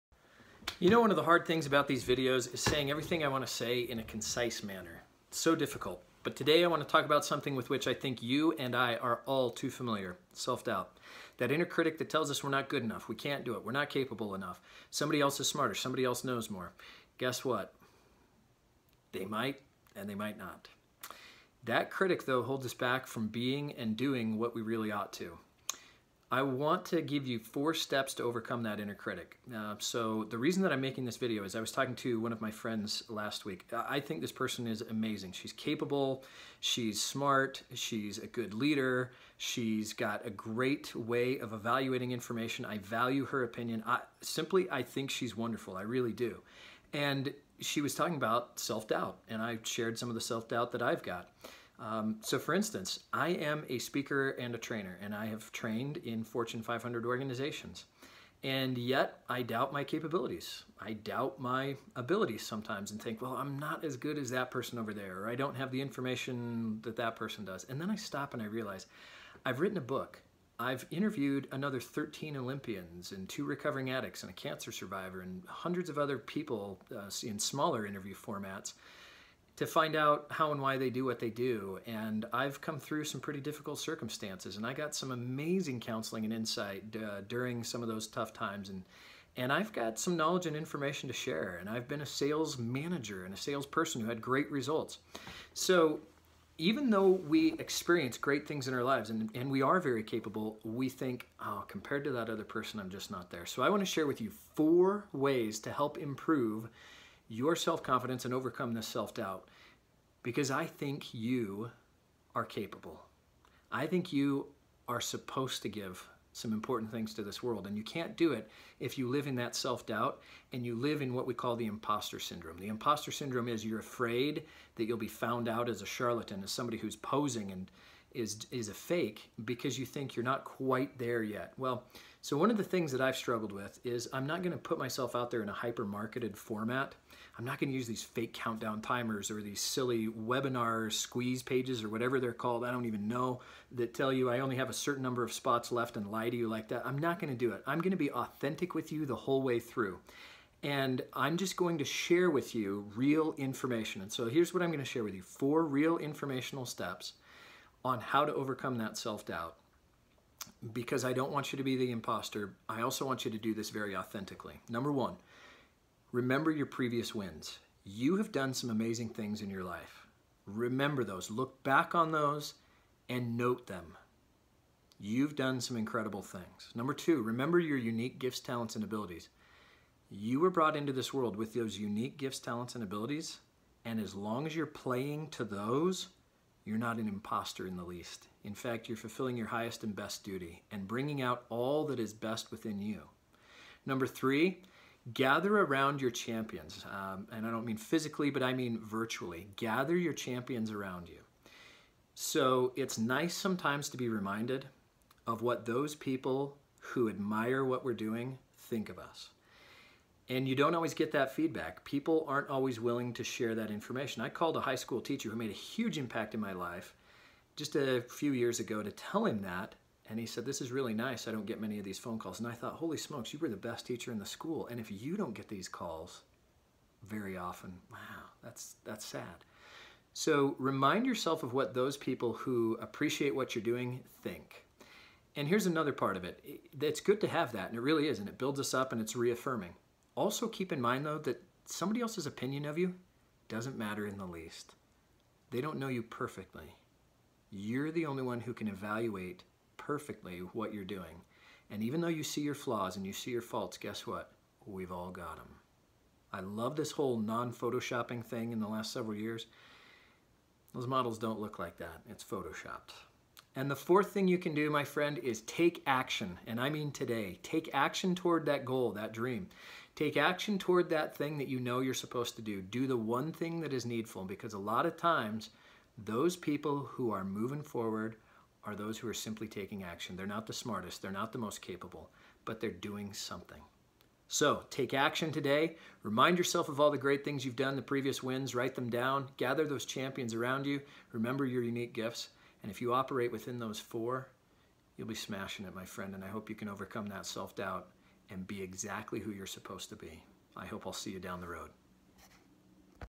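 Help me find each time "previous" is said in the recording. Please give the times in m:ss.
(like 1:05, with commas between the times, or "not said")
2:46, 4:47.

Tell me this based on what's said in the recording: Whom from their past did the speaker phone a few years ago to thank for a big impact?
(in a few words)
high school teacher.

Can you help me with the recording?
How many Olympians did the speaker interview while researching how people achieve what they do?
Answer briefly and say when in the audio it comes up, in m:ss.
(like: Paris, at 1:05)
13, at 1:11.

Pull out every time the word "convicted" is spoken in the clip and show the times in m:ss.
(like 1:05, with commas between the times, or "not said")
not said.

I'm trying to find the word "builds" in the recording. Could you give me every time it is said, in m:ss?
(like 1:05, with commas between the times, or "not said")
3:58.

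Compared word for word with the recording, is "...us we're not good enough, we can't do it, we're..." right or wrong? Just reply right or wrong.
right.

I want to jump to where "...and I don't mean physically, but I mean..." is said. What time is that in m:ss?
3:17.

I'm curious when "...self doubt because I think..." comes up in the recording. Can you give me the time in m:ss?
1:48.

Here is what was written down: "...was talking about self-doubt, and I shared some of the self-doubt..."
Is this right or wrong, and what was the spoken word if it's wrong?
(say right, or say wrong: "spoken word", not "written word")
right.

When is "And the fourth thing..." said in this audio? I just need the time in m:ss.
4:23.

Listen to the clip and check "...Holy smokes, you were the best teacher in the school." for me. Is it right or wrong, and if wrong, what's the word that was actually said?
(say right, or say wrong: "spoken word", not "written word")
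right.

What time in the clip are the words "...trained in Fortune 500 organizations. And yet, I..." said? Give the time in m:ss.
0:55.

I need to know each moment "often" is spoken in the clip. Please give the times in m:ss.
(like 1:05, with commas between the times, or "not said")
3:47.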